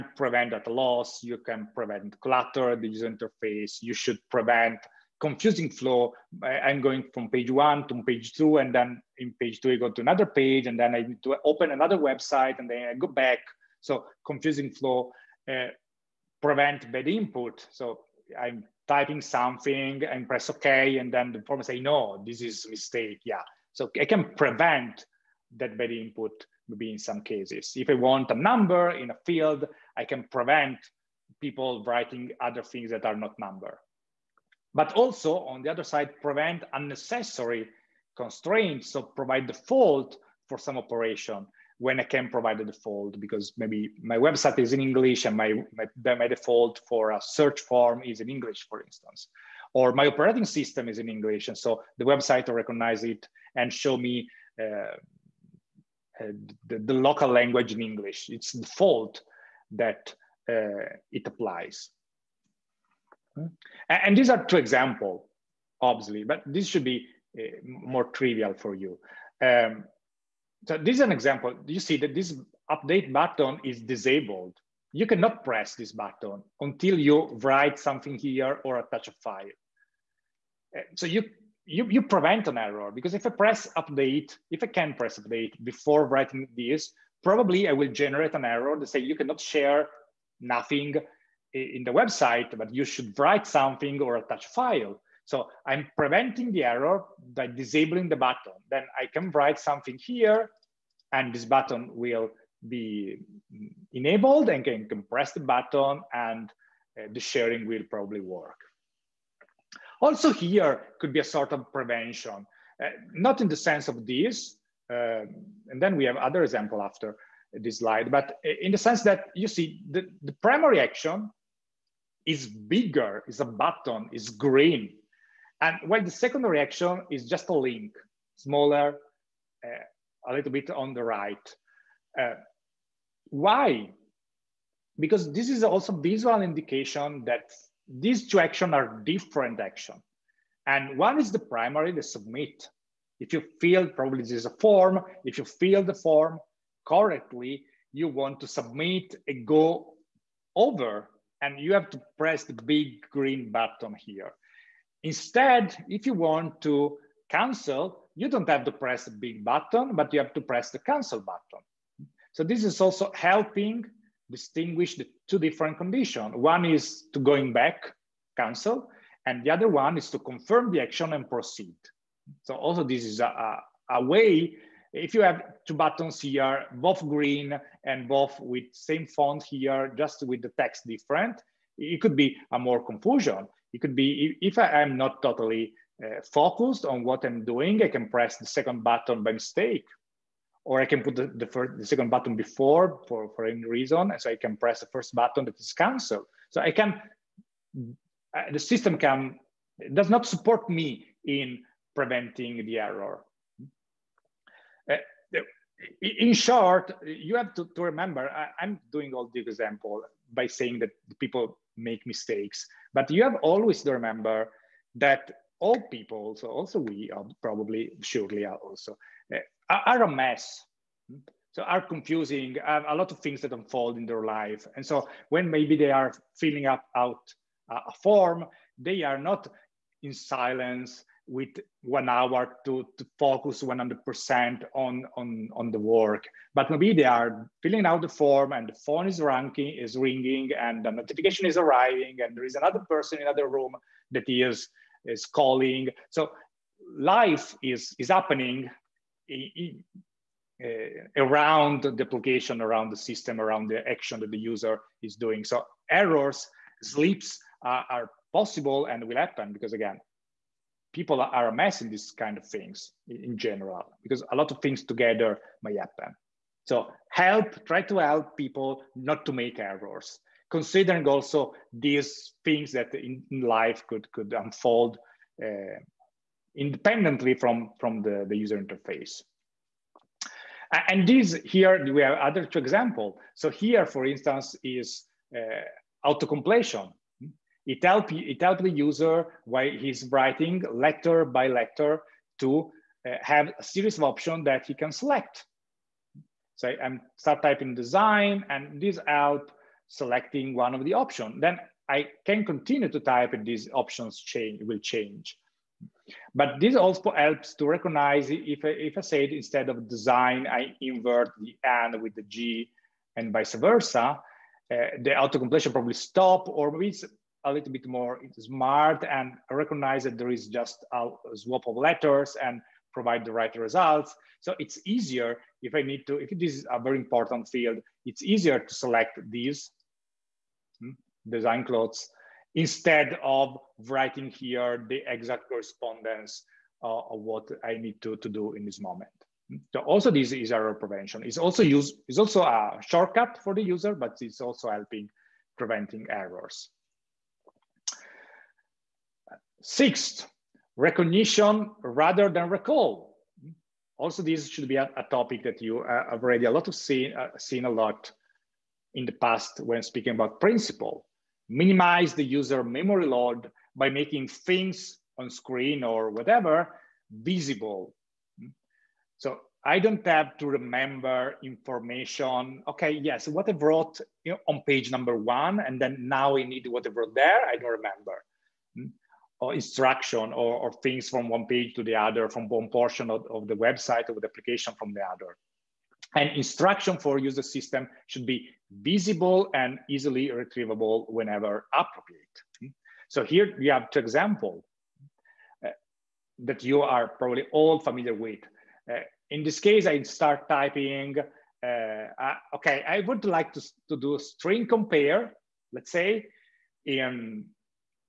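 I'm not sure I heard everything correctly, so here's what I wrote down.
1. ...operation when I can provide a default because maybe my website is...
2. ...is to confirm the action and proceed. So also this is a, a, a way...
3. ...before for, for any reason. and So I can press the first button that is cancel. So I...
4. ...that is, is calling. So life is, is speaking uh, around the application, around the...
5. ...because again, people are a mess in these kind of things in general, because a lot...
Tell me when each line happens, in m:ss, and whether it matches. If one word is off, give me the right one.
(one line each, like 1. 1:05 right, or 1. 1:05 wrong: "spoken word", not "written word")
1. 0:40 right
2. 2:49 right
3. 3:12 right
4. 4:04 wrong: "happening", not "speaking"
5. 4:19 right.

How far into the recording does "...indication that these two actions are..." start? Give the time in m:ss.
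2:16.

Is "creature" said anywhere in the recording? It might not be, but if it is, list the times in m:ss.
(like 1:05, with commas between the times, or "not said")
not said.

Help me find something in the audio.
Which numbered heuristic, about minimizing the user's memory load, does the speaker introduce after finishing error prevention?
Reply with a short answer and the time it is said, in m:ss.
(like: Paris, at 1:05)
Sixth, at 5:49.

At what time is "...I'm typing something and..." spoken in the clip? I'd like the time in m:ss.
0:18.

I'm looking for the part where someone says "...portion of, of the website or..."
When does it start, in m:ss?
6:22.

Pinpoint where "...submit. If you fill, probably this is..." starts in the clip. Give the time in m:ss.
2:22.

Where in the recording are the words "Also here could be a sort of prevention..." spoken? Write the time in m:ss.
1:50.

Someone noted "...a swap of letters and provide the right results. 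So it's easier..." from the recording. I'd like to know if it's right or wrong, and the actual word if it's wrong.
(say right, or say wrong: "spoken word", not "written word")
right.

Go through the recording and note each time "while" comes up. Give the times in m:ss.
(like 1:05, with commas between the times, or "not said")
2:05, 4:49.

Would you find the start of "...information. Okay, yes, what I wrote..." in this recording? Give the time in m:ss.
6:11.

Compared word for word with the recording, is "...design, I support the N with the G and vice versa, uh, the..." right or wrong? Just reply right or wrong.
wrong.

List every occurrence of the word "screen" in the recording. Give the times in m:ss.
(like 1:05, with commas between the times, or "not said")
6:05.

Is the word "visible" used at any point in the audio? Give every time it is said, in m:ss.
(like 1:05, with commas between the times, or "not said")
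6:07, 6:28.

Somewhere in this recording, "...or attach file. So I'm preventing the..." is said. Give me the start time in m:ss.
1:33.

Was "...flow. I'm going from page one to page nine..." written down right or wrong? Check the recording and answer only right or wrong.
wrong.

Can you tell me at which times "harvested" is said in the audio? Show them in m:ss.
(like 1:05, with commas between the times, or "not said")
not said.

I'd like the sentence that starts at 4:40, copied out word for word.
And these here, we have other two example.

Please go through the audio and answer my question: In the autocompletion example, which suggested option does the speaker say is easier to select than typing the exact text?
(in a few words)
design clothes.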